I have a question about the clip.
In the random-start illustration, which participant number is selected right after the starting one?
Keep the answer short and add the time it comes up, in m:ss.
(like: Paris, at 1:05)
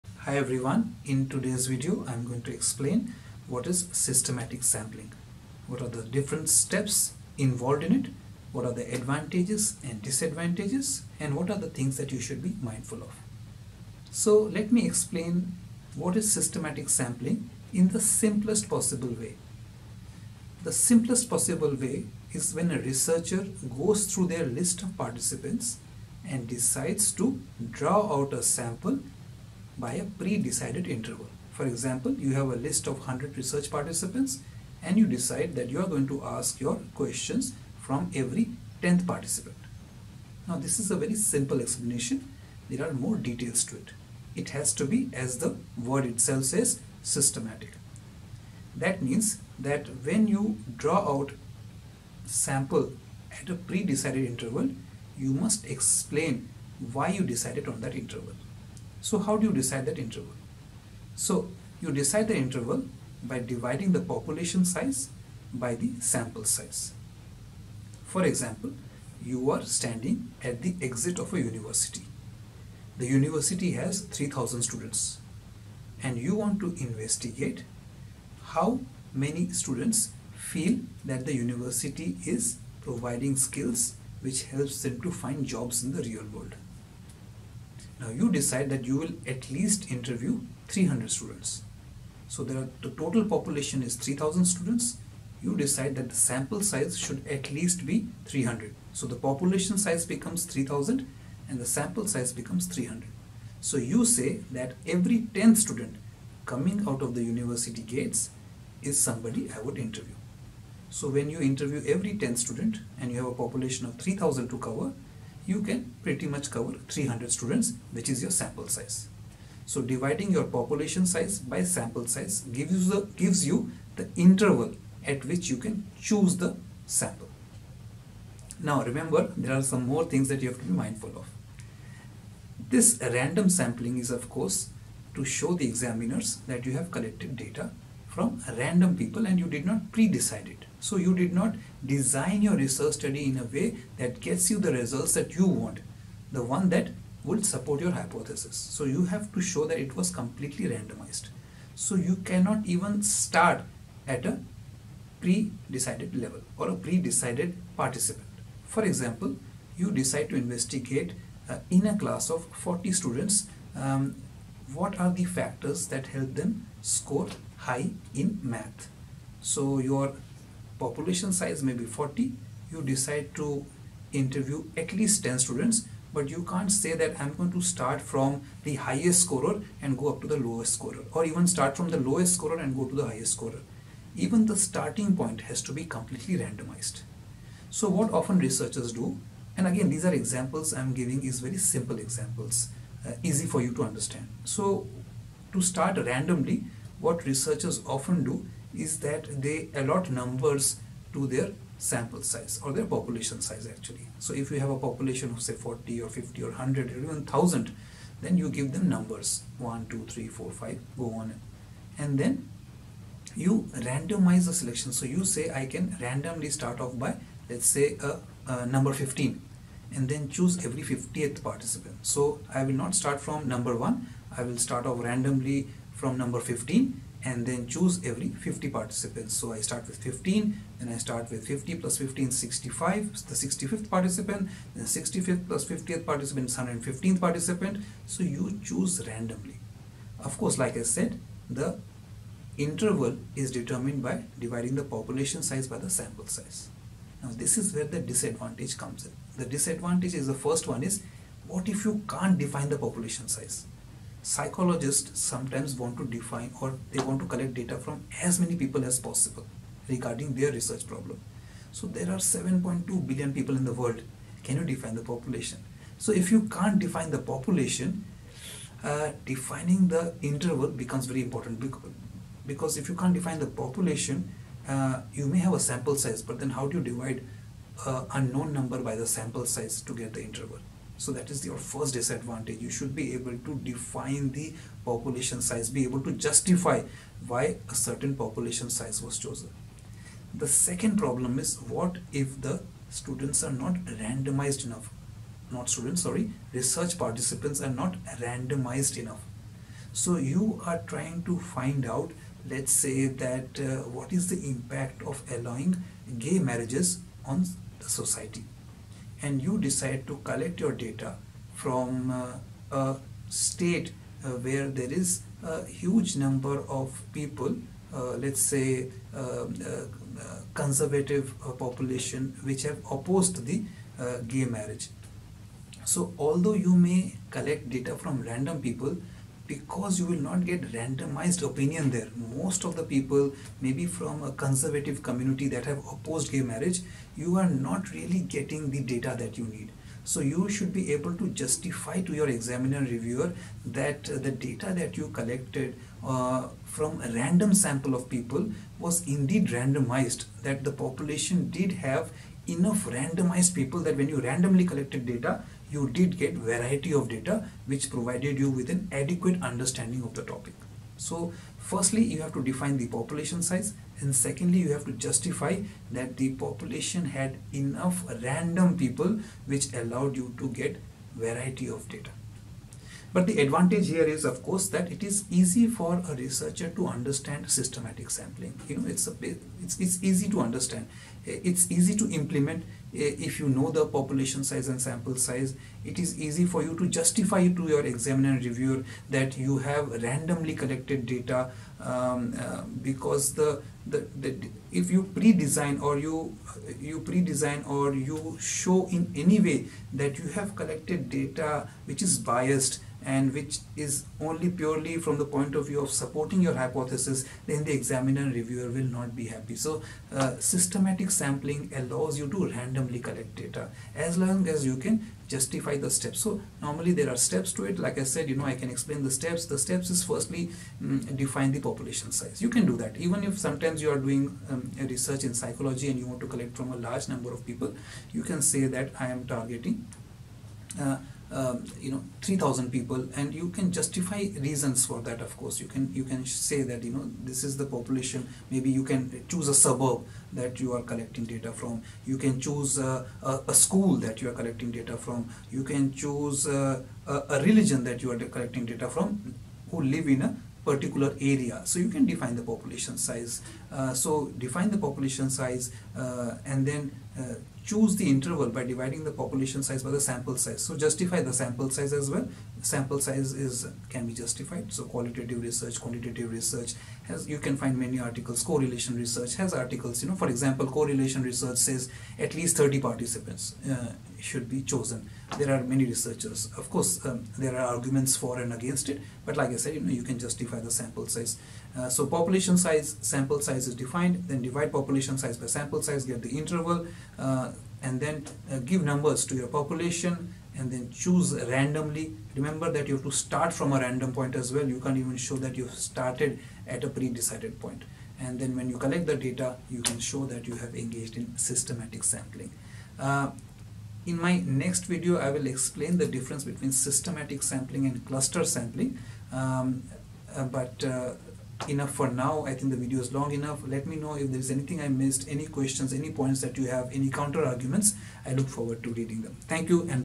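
65, at 3:53.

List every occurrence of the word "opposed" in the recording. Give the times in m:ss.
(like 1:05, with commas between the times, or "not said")
5:22, 5:35.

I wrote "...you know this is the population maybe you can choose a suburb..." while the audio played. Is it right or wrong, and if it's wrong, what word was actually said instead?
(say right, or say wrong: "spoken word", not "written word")
right.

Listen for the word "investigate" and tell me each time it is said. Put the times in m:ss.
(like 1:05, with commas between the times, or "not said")
1:16, 2:40.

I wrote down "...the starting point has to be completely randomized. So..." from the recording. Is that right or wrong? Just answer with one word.
right.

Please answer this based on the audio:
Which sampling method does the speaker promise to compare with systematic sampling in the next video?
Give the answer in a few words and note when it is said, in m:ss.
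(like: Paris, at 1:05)
cluster sampling, at 8:28.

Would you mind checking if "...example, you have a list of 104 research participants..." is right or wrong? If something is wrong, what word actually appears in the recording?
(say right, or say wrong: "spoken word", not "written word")
wrong: "100", not "104".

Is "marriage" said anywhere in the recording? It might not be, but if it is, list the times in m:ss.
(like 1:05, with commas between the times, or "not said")
5:06, 5:24, 5:36.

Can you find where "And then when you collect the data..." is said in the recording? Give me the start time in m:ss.
8:18.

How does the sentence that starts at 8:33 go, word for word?
Let me know if there's anything I missed, any questions, any points that you have, any counter arguments.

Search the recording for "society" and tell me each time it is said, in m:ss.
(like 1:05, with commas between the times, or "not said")
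5:08.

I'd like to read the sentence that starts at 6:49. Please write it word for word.
So uh, systematic sampling allows you to randomly collect data as long as you can justify the steps.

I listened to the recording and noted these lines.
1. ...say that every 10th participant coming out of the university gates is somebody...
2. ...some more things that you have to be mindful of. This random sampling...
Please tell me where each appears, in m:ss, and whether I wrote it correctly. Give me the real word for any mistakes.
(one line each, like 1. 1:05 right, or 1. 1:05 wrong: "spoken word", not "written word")
1. 1:44 wrong: "student", not "participant"
2. 2:09 right.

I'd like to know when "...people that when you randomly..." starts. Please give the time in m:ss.
5:53.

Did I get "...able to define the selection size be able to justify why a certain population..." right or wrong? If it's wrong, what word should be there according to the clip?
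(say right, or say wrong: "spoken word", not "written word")
wrong: "population", not "selection".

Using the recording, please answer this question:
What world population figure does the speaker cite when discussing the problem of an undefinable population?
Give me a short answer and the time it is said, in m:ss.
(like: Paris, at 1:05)
7.2 billion, at 4:22.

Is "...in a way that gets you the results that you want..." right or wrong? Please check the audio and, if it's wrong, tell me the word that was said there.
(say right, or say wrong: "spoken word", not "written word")
right.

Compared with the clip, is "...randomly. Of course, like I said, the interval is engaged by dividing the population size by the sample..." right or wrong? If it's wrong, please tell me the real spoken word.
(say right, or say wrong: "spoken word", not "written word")
wrong: "determined", not "engaged".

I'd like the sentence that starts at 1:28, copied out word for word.
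Now you decide that you will at least interview 300 students.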